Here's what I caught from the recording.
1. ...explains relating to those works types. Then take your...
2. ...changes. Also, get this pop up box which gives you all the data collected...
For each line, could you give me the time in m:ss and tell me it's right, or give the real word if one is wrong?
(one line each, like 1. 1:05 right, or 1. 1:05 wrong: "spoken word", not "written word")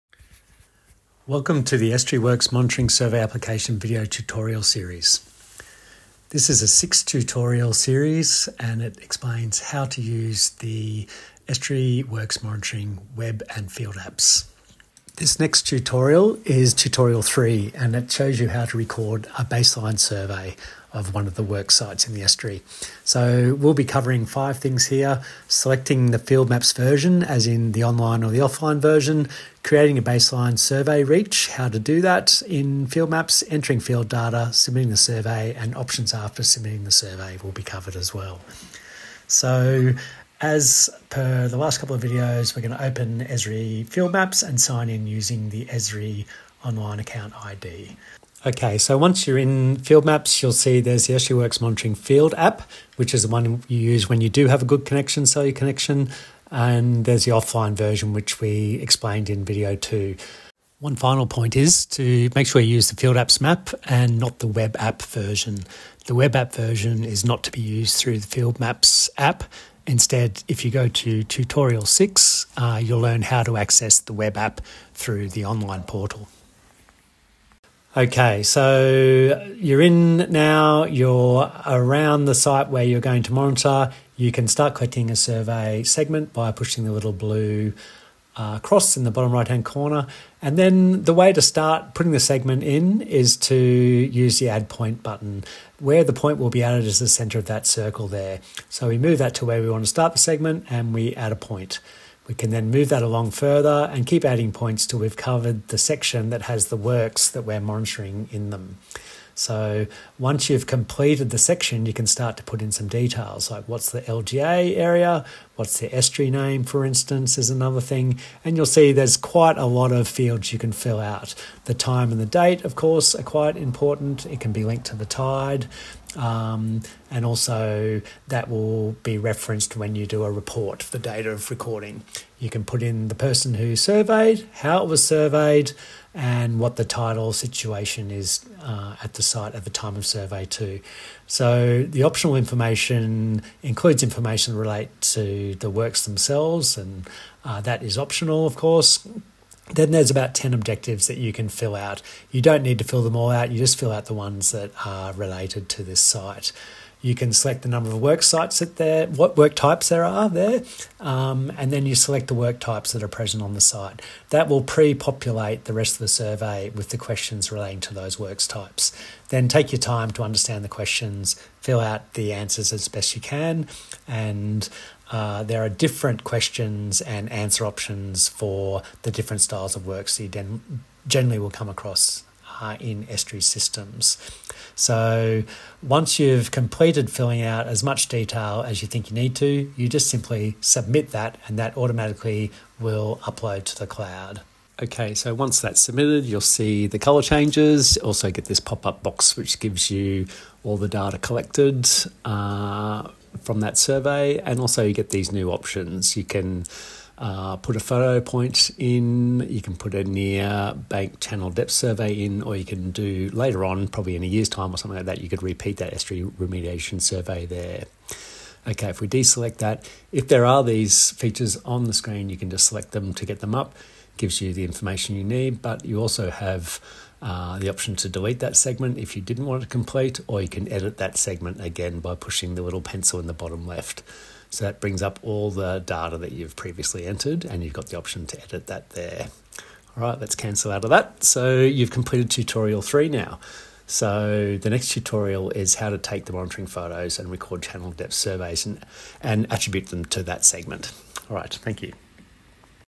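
1. 2:46 wrong: "questions", not "explains"
2. 3:17 right.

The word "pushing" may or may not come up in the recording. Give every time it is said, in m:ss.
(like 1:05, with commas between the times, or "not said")
1:26, 3:52.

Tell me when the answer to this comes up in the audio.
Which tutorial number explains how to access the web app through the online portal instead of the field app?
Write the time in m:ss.
1:11.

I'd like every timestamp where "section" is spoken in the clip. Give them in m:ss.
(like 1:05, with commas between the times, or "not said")
1:45, 1:51.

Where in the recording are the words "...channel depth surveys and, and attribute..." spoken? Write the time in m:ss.
4:07.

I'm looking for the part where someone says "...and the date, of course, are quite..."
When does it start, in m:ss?
2:02.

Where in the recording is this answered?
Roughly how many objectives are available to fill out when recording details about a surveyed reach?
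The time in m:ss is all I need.
2:30.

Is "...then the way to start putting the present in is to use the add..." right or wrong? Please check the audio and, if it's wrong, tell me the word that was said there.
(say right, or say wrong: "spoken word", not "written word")
wrong: "segment", not "present".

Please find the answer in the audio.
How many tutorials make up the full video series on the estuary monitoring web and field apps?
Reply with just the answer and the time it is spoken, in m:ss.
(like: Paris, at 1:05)
6, at 0:06.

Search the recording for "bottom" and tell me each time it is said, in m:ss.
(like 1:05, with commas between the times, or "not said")
1:29, 3:53.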